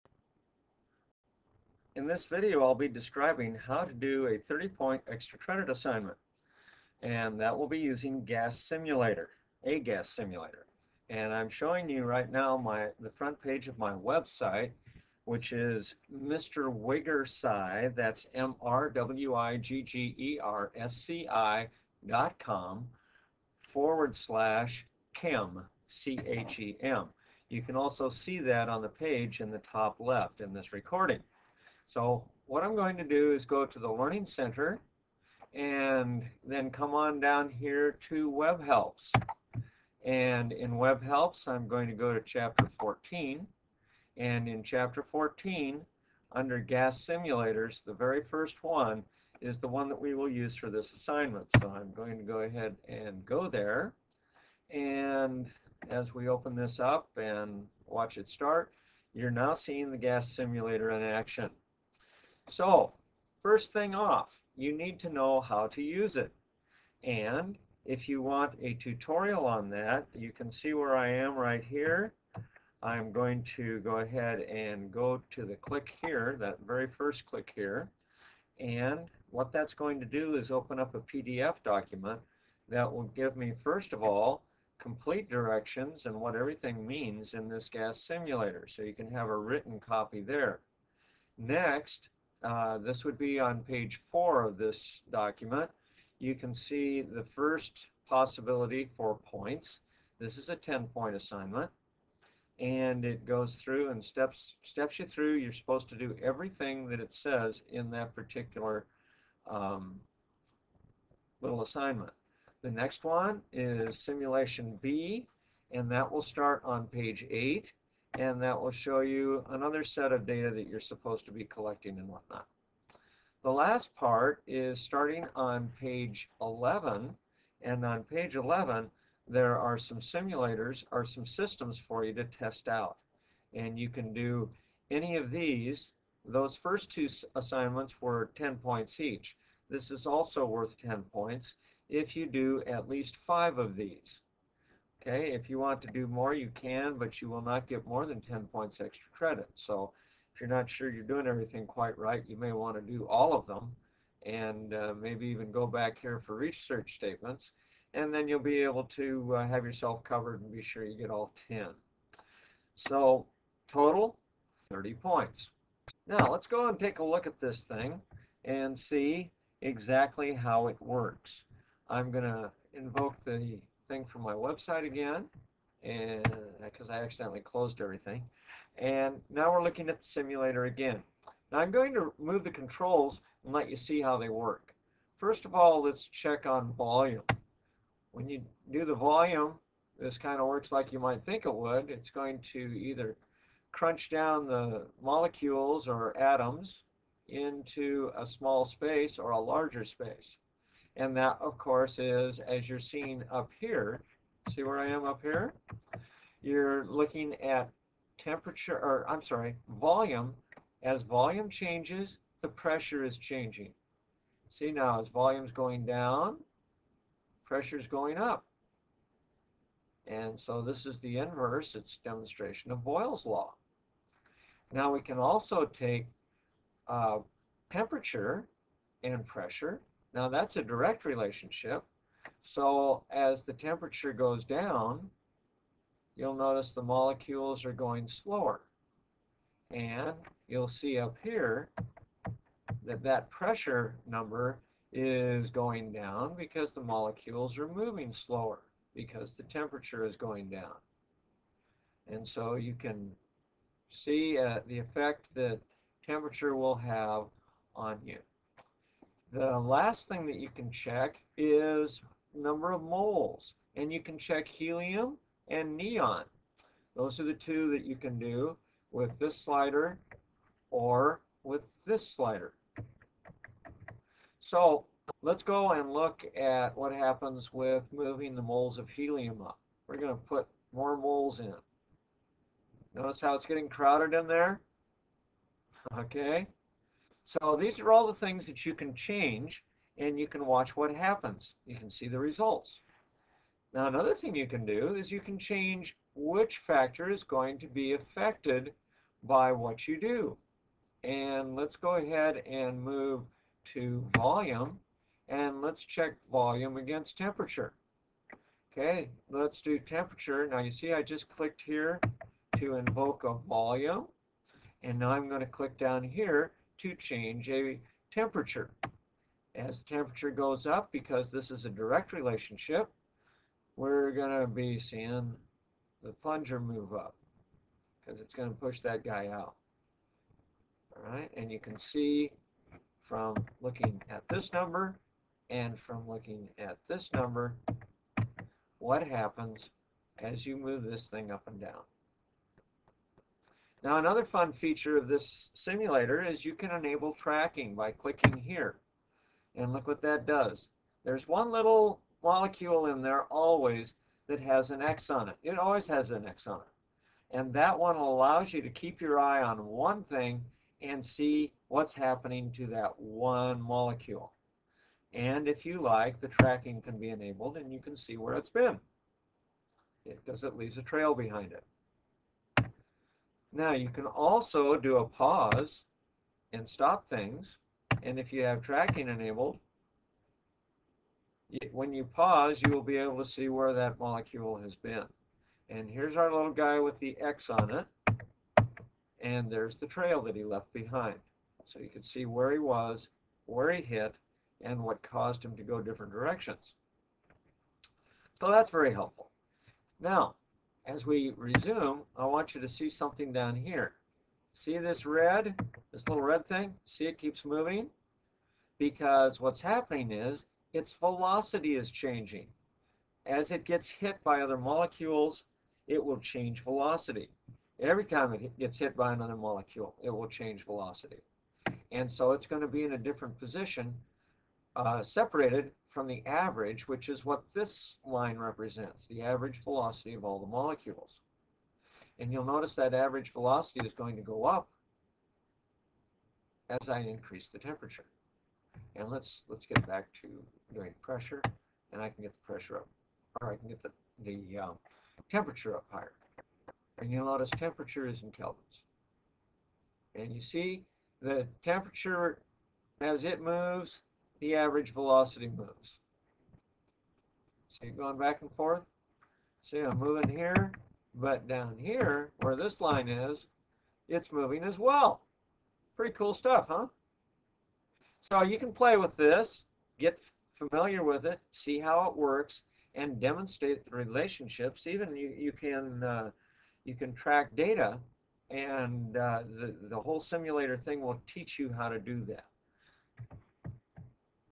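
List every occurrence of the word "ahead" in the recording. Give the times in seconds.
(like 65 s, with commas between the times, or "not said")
52 s, 73 s, 301 s.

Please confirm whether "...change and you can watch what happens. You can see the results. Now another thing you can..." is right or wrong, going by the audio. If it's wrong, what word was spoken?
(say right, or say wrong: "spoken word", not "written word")
right.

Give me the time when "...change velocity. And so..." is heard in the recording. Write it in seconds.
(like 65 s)
420 s.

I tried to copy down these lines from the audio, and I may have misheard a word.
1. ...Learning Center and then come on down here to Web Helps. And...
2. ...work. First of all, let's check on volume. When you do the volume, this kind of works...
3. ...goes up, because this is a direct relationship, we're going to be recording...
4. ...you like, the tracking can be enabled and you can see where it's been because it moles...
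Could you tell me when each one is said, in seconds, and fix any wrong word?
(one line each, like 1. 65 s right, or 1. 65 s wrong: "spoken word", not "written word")
1. 33 s right
2. 184 s right
3. 320 s wrong: "seeing", not "recording"
4. 365 s wrong: "leaves", not "moles".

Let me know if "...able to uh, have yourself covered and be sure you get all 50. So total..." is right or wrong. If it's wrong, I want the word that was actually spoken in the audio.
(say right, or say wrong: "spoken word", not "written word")
wrong: "10", not "50".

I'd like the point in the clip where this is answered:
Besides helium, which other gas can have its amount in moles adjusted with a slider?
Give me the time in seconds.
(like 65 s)
265 s.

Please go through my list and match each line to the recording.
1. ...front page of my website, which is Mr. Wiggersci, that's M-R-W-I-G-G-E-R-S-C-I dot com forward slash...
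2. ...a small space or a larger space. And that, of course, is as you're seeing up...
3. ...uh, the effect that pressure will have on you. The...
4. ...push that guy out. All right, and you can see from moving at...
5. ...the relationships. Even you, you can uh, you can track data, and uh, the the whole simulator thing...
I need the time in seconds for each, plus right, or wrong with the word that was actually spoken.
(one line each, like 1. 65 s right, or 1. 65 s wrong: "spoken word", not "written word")
1. 13 s right
2. 198 s right
3. 254 s wrong: "temperature", not "pressure"
4. 328 s wrong: "looking", not "moving"
5. 473 s right.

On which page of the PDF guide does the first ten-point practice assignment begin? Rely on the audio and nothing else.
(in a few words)
4.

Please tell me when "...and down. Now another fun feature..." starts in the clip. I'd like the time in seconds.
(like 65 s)
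341 s.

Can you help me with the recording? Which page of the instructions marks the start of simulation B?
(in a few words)
8.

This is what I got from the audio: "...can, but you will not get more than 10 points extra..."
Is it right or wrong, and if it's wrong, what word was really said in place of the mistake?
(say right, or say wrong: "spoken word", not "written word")
right.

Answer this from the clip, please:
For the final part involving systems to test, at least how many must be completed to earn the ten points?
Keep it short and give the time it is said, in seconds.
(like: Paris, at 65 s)
5, at 143 s.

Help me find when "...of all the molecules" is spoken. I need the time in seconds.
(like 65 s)
430 s.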